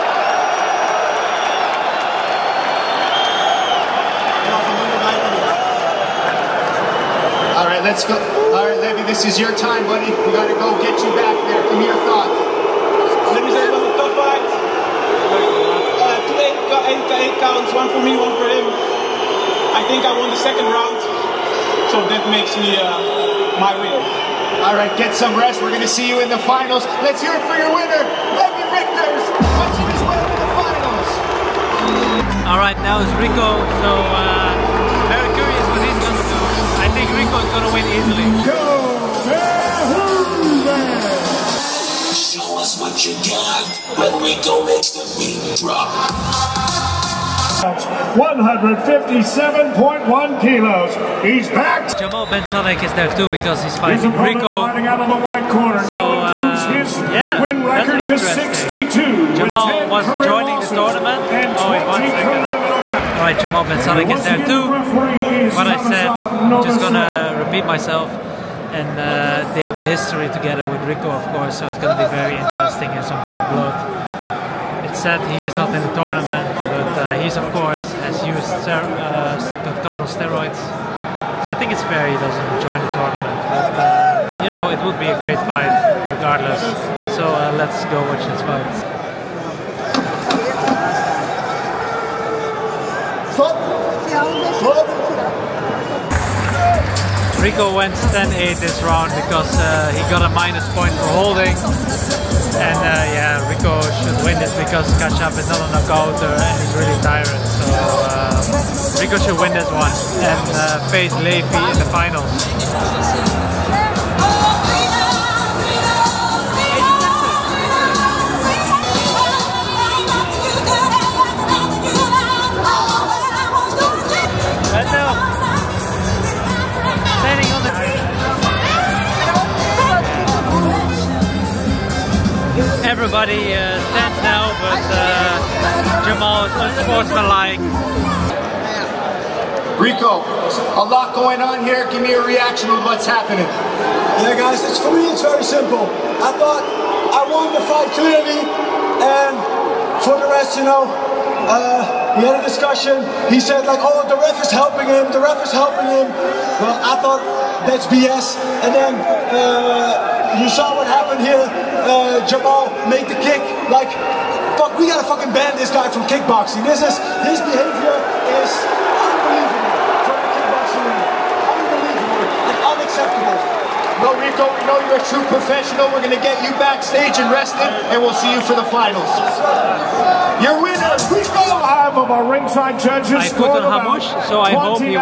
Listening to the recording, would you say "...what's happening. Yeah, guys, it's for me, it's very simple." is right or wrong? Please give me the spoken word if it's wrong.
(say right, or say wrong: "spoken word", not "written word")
right.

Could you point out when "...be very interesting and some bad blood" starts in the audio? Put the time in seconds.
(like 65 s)
72 s.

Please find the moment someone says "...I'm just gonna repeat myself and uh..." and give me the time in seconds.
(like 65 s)
66 s.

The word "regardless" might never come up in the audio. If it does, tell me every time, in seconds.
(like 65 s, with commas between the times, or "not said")
86 s.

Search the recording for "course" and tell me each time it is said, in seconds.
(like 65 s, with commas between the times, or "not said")
71 s, 77 s.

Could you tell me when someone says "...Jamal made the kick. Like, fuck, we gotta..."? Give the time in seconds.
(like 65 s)
162 s.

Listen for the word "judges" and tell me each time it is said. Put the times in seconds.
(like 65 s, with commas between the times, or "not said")
182 s.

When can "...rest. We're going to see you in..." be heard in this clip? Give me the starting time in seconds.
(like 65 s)
25 s.